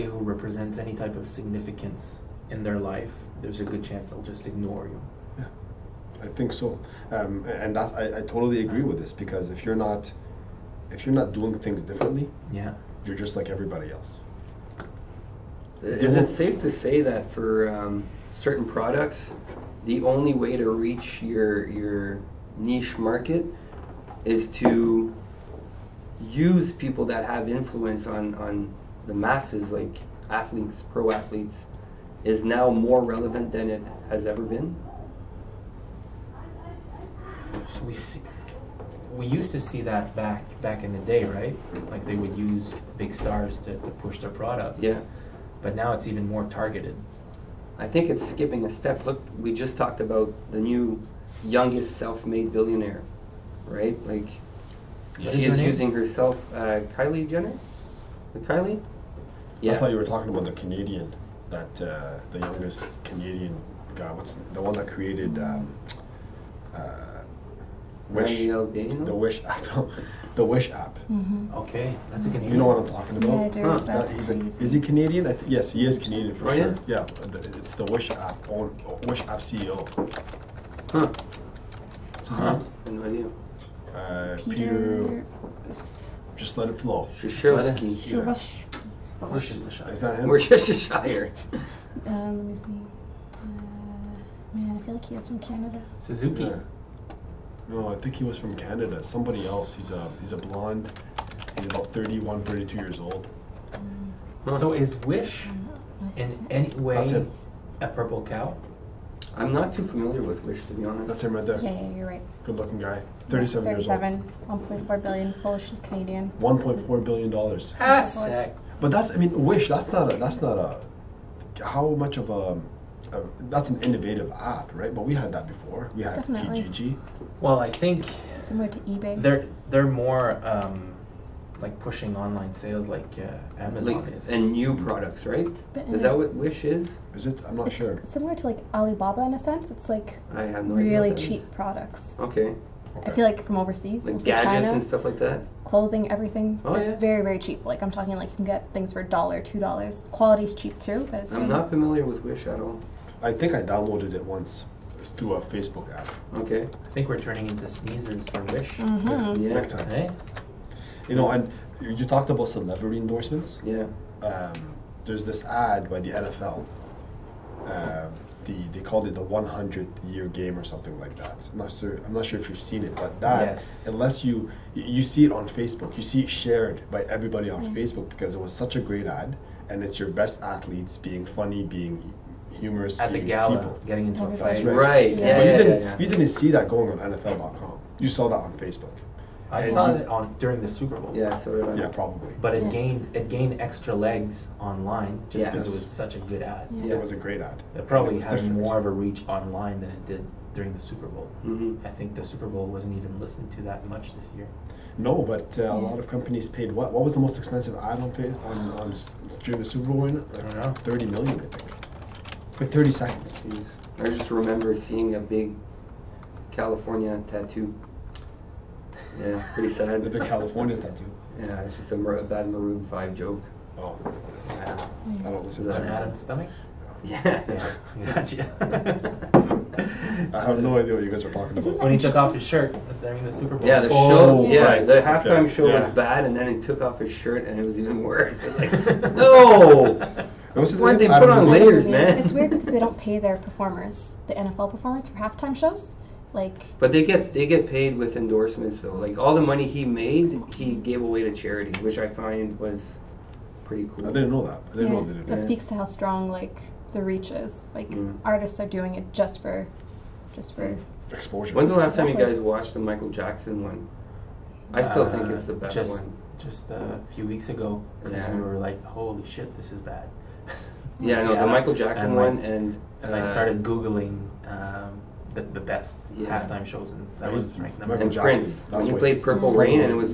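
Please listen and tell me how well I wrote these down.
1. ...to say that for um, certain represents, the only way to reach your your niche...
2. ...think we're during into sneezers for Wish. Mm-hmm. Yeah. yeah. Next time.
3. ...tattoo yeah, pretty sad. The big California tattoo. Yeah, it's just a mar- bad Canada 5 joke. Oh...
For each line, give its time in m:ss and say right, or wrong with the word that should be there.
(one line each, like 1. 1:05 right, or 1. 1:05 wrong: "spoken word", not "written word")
1. 0:16 wrong: "products", not "represents"
2. 2:36 wrong: "turning", not "during"
3. 3:37 wrong: "Maroon", not "Canada".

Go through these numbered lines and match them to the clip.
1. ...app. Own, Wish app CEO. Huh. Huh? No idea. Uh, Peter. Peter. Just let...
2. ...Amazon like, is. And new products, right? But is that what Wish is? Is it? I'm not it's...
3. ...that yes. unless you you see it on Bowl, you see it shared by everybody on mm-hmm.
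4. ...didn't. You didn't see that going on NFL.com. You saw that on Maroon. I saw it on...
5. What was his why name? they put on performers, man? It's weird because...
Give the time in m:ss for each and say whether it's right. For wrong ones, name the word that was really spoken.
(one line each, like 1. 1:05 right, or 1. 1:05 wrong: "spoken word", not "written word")
1. 1:18 right
2. 2:13 right
3. 2:53 wrong: "Facebook", not "Bowl"
4. 3:05 wrong: "Facebook", not "Maroon"
5. 3:59 wrong: "layers", not "performers".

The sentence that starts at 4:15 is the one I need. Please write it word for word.
know that that speaks to how strong like the reach is like mm.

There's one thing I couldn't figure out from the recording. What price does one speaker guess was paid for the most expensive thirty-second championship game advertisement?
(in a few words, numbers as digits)
30 million.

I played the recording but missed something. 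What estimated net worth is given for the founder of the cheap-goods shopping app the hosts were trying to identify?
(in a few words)
1.4 billion dollars.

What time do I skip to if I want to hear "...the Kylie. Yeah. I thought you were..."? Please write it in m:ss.
0:58.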